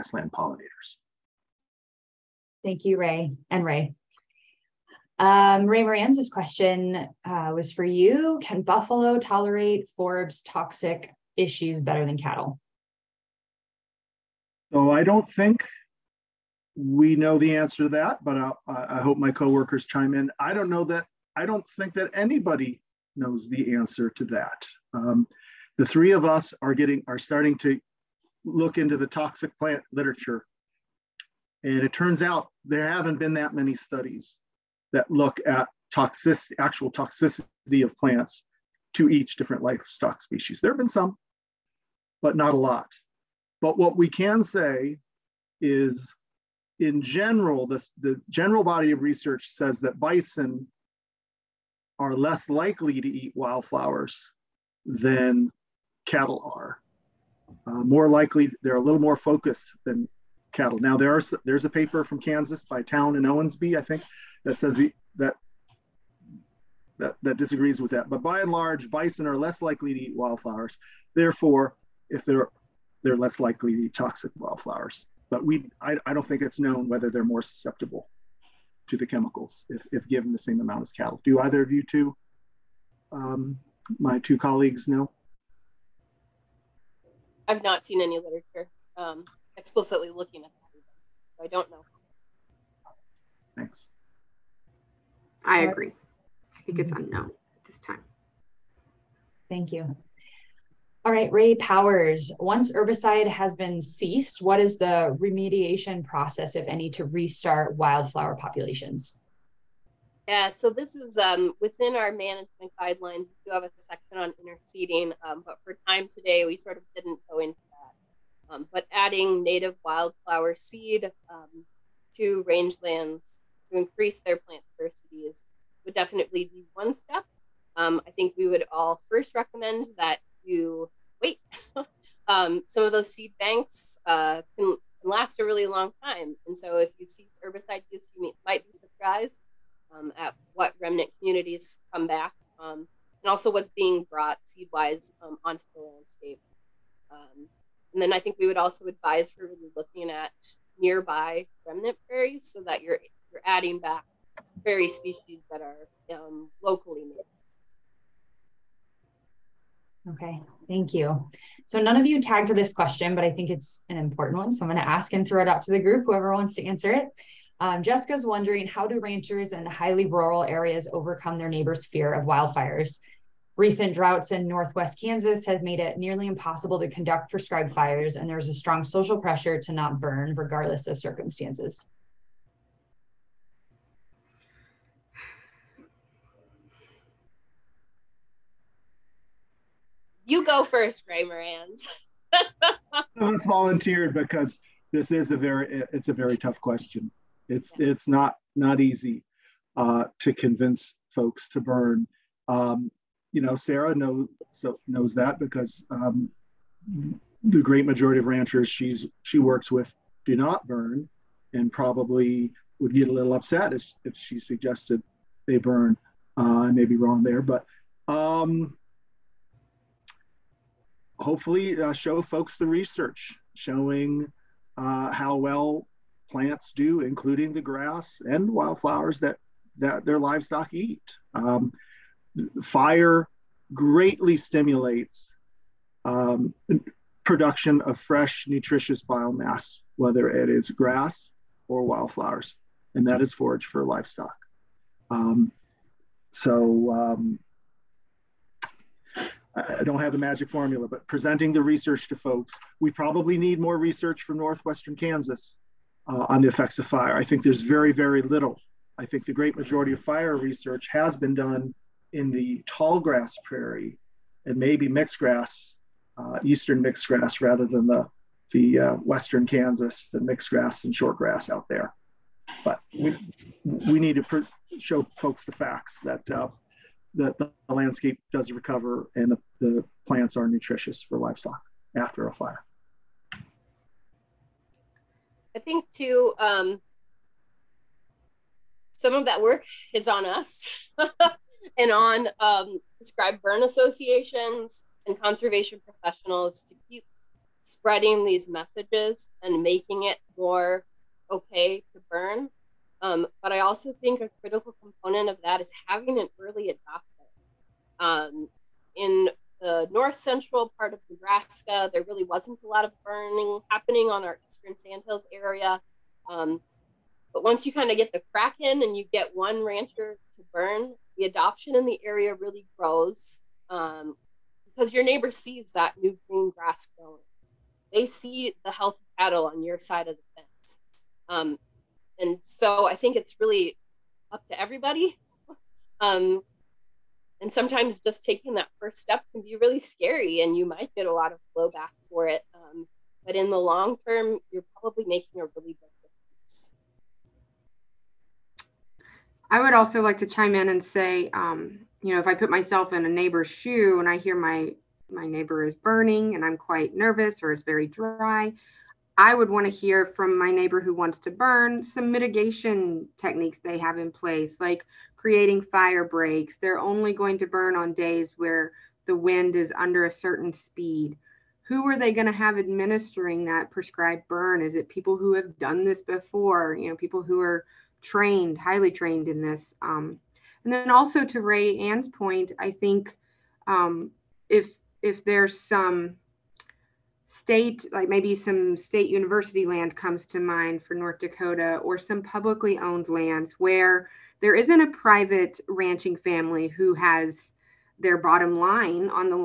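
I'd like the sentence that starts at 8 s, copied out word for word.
Can buffalo tolerate forbs toxic issues better than cattle?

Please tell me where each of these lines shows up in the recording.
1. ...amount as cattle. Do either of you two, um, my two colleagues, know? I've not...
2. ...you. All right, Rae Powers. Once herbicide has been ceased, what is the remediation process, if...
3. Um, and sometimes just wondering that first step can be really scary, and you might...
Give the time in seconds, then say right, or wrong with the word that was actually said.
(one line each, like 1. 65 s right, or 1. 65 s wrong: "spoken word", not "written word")
1. 80 s right
2. 99 s right
3. 336 s wrong: "taking", not "wondering".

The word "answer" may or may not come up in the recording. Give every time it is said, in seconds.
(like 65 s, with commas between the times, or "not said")
17 s, 23 s, 166 s.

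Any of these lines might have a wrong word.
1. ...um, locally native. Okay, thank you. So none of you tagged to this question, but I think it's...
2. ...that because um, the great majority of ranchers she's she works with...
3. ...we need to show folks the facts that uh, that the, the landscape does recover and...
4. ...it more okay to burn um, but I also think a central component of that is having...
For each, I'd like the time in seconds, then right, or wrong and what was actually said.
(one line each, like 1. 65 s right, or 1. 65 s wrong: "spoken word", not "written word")
1. 156 s right
2. 205 s right
3. 273 s right
4. 300 s wrong: "critical", not "central".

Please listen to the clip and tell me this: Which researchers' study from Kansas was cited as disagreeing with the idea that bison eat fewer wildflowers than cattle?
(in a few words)
Towne and Owensby.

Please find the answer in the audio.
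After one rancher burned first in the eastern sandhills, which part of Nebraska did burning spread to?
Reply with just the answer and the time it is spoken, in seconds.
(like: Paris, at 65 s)
North central, at 309 s.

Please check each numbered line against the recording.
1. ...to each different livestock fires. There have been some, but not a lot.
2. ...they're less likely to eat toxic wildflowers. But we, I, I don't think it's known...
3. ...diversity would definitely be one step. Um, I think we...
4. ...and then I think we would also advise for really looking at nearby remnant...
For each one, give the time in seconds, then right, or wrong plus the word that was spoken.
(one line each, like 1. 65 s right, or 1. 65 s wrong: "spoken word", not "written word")
1. 38 s wrong: "species", not "fires"
2. 73 s right
3. 124 s right
4. 147 s right.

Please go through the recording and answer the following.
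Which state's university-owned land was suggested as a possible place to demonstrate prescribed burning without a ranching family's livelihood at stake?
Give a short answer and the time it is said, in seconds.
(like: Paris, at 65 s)
North Dakota, at 390 s.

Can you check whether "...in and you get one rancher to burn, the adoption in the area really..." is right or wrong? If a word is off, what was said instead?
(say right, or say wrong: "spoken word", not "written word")
right.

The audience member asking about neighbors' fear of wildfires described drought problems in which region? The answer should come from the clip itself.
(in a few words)
Northwest Kansas.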